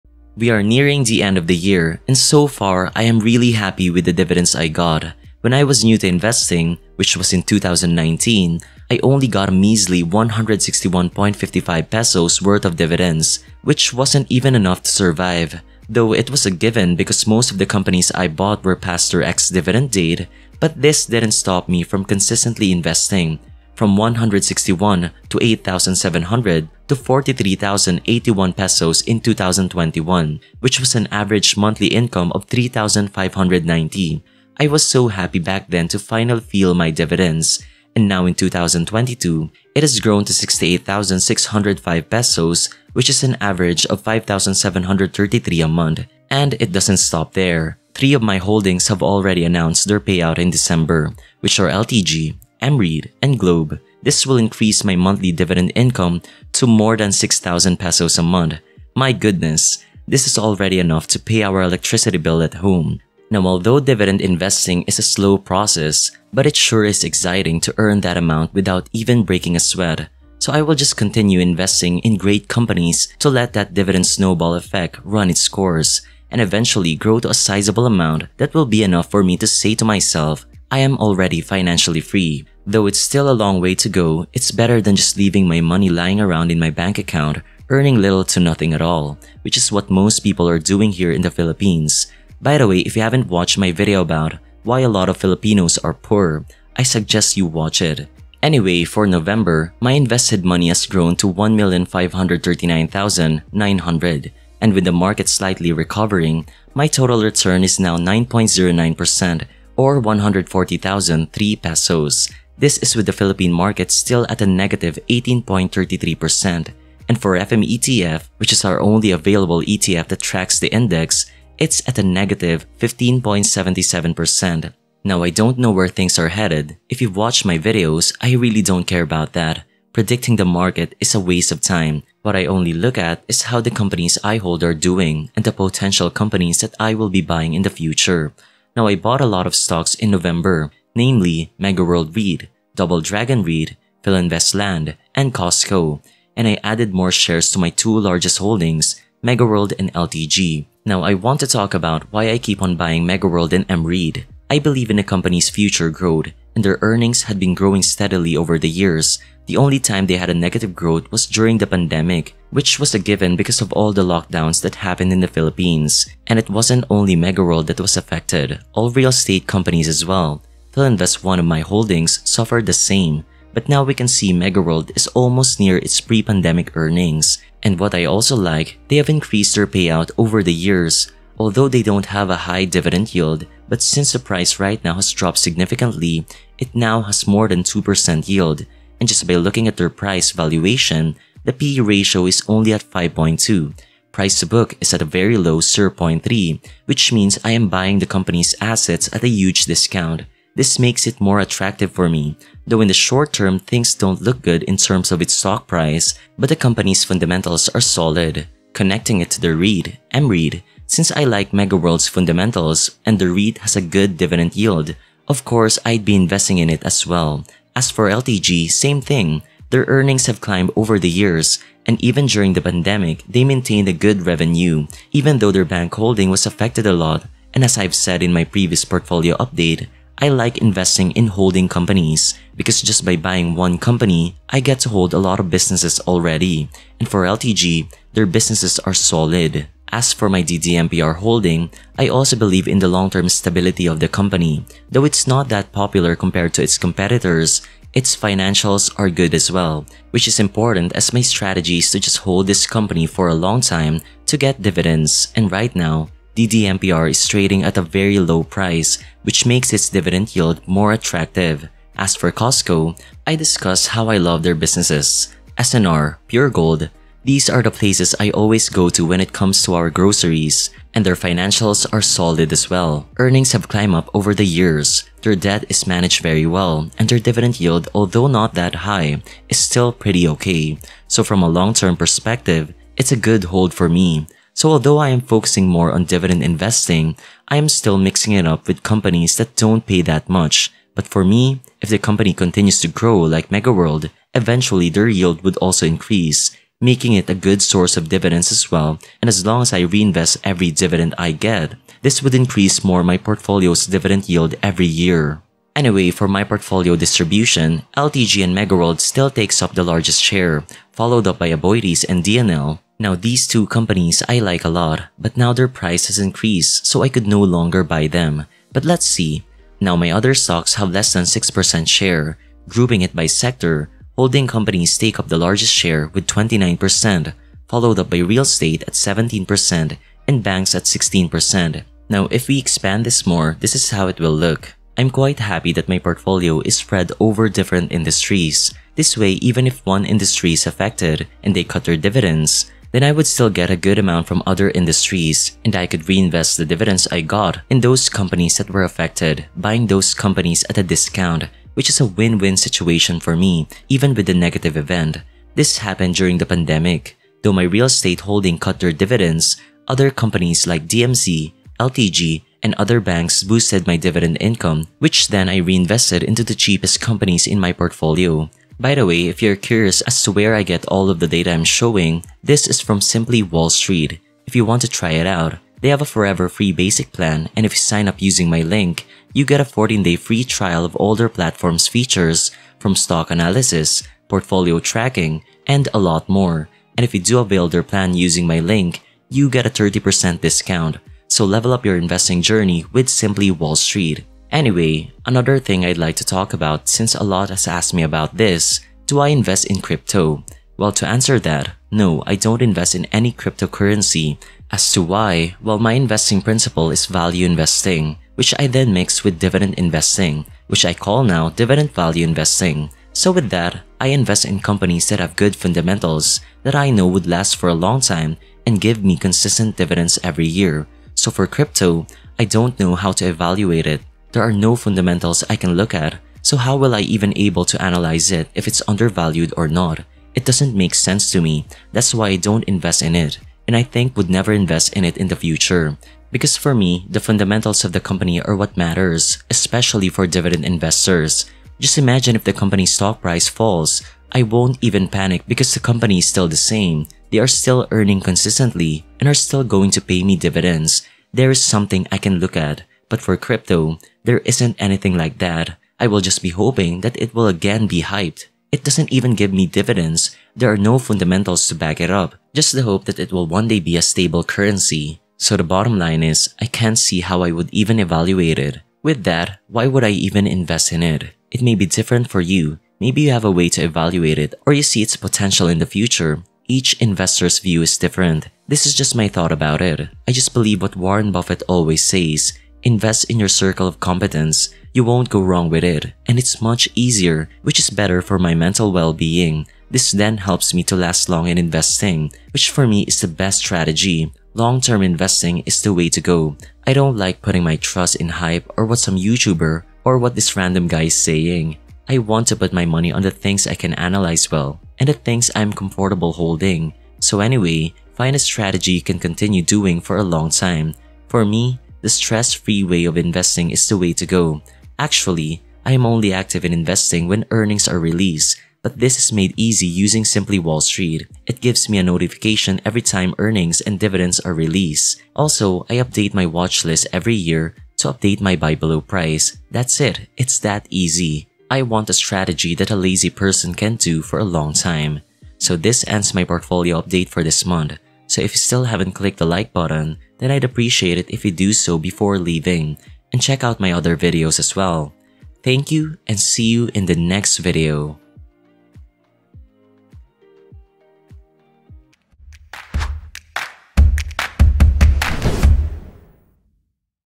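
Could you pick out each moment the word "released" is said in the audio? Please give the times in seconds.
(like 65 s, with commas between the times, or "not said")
517 s, 524 s.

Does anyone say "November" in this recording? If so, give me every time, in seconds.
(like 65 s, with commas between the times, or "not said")
99 s, 140 s.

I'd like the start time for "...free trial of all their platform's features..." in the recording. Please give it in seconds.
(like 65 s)
380 s.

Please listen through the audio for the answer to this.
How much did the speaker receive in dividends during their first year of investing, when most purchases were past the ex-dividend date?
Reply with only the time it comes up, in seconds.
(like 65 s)
10 s.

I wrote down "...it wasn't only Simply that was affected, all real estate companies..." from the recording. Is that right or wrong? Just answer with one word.
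wrong.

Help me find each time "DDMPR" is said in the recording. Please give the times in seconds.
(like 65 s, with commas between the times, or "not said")
240 s, 256 s.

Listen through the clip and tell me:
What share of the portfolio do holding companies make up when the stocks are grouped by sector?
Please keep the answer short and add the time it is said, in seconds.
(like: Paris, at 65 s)
29%, at 326 s.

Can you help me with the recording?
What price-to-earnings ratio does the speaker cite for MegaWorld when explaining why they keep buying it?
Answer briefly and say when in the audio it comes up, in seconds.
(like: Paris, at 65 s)
5.2, at 192 s.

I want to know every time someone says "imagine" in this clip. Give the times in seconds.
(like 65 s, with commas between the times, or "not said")
441 s.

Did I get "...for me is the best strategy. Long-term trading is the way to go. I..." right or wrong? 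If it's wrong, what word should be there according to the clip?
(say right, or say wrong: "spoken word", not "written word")
wrong: "investing", not "trading".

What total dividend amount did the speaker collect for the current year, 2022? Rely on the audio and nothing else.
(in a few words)
68,605 pesos.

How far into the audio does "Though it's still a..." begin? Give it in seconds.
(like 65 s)
82 s.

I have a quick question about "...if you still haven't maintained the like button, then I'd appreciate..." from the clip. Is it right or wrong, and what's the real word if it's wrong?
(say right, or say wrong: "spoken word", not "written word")
wrong: "clicked", not "maintained".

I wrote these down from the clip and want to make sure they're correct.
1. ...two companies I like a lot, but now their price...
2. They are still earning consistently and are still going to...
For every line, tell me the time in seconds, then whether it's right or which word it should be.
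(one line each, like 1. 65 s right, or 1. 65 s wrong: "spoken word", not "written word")
1. 313 s right
2. 447 s right.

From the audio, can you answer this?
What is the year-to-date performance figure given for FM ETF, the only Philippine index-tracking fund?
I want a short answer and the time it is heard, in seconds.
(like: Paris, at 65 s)
negative 15.77%, at 122 s.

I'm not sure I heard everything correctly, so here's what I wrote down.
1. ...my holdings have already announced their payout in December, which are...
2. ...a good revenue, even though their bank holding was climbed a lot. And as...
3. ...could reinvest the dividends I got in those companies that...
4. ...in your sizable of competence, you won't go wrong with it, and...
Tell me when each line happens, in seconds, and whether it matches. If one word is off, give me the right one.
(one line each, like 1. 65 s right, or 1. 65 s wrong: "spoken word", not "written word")
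1. 48 s right
2. 223 s wrong: "affected", not "climbed"
3. 345 s right
4. 483 s wrong: "circle", not "sizable".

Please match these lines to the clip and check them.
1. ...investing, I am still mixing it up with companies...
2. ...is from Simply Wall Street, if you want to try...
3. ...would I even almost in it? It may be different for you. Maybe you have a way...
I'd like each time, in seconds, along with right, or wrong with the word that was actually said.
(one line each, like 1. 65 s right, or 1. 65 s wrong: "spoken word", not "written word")
1. 286 s right
2. 372 s right
3. 469 s wrong: "invest", not "almost".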